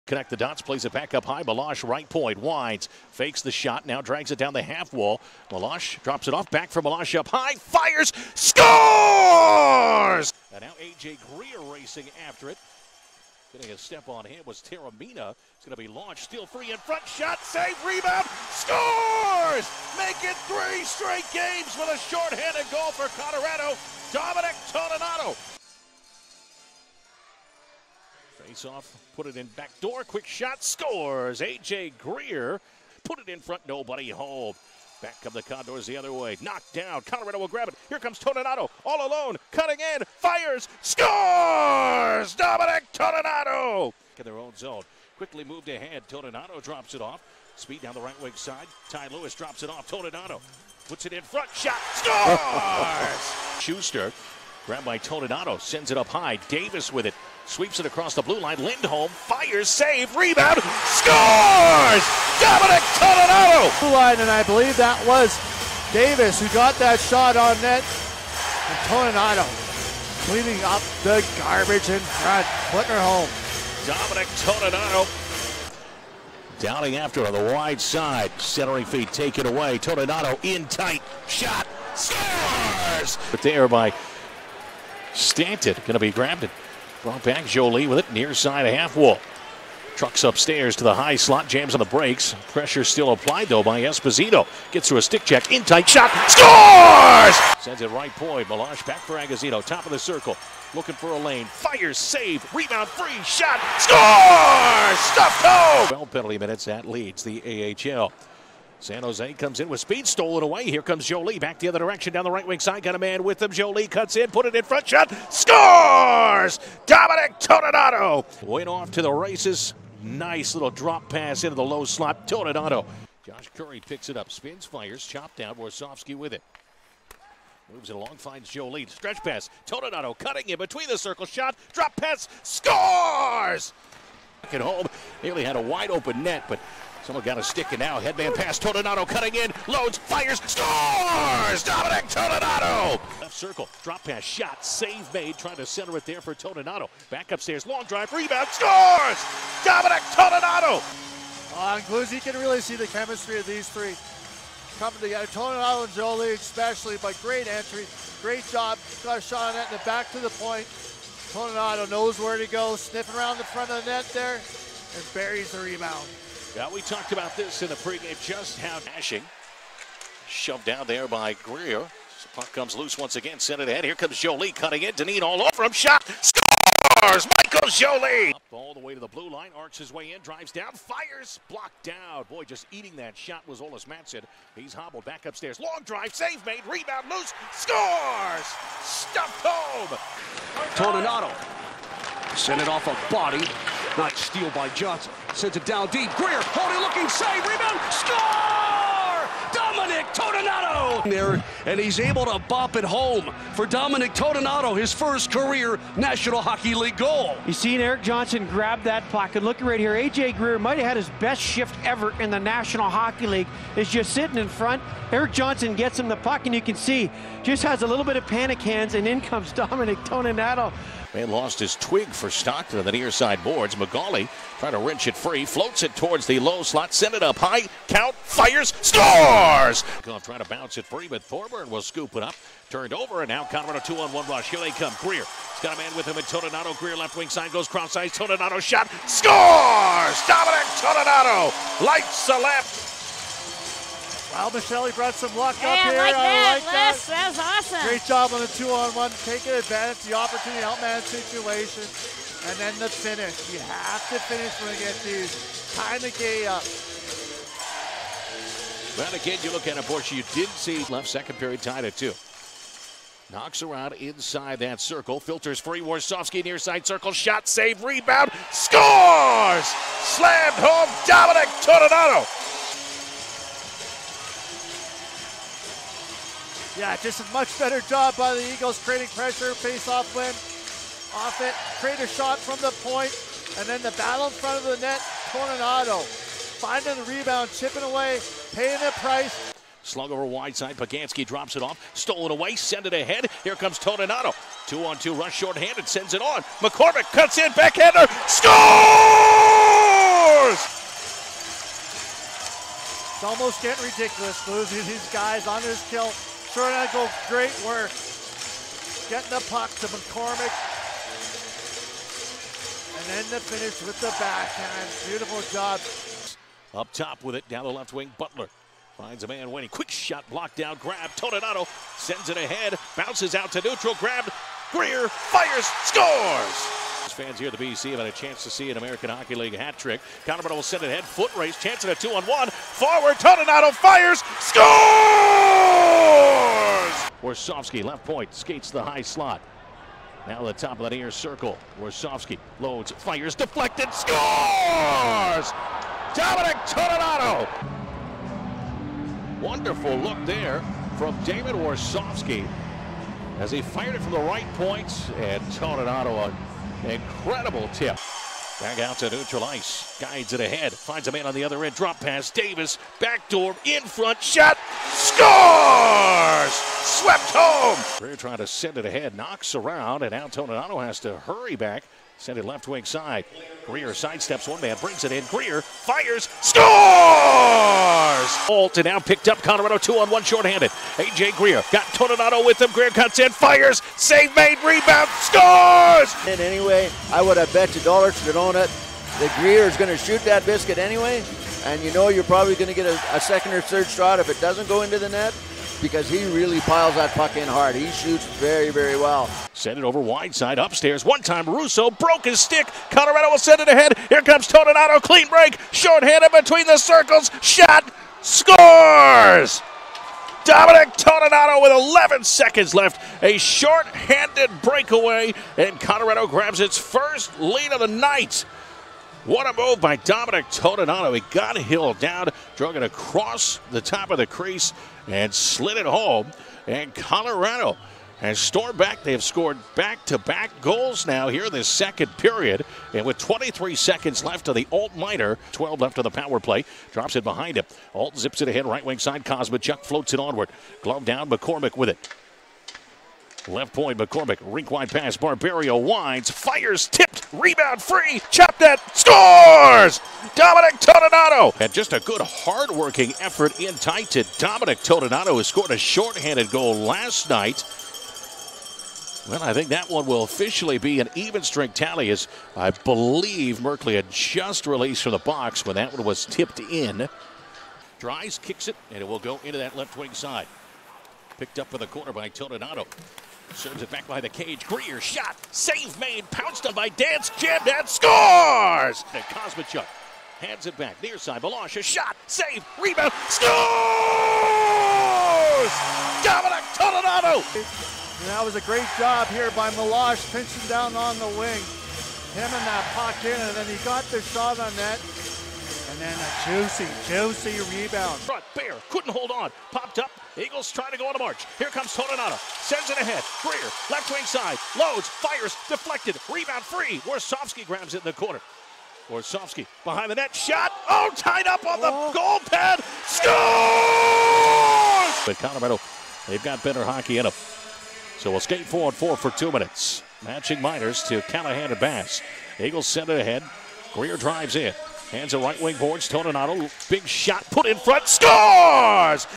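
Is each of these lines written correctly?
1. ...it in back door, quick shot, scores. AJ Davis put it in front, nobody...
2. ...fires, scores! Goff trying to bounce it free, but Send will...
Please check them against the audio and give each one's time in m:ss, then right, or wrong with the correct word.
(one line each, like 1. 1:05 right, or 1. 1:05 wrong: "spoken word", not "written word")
1. 0:29 wrong: "Greer", not "Davis"
2. 3:48 wrong: "Thorburn", not "Send".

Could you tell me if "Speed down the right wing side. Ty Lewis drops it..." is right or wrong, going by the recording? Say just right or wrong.
right.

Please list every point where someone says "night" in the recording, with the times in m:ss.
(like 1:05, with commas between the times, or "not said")
6:57, 7:37.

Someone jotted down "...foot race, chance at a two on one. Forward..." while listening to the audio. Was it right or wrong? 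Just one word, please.
right.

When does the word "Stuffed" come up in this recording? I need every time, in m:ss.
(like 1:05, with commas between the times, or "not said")
1:44, 3:08.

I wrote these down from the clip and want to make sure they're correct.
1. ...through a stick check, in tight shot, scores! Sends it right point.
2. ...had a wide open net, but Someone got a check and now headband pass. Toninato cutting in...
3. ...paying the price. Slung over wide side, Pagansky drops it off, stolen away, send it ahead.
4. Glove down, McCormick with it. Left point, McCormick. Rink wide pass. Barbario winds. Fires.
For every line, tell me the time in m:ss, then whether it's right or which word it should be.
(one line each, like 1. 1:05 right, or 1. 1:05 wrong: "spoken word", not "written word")
1. 1:34 right
2. 2:15 wrong: "stick", not "check"
3. 4:48 right
4. 7:20 right.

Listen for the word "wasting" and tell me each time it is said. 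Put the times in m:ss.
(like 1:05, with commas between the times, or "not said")
not said.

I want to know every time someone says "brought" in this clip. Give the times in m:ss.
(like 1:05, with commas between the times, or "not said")
1:27, 4:04.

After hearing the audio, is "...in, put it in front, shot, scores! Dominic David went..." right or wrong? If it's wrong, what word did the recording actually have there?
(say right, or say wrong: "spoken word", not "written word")
wrong: "Toninato", not "David".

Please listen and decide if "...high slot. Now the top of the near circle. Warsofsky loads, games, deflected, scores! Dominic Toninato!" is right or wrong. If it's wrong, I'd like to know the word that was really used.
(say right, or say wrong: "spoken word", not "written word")
wrong: "fires", not "games".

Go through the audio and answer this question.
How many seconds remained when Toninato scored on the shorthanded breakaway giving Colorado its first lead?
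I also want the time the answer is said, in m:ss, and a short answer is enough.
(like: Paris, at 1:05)
11, at 6:51.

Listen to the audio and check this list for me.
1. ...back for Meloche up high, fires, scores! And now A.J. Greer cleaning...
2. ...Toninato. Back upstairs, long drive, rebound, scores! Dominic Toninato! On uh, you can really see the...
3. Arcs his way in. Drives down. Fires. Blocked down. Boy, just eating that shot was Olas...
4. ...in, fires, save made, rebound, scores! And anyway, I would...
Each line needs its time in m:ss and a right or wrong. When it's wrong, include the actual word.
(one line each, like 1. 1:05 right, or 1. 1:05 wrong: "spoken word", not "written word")
1. 0:06 wrong: "racing", not "cleaning"
2. 2:26 right
3. 2:59 right
4. 6:23 right.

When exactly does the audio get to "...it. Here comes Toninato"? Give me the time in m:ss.
0:37.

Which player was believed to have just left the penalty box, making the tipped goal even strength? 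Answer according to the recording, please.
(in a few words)
Merkley.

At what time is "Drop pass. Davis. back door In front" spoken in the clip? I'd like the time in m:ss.
6:01.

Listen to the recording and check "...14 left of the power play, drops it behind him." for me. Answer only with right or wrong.
wrong.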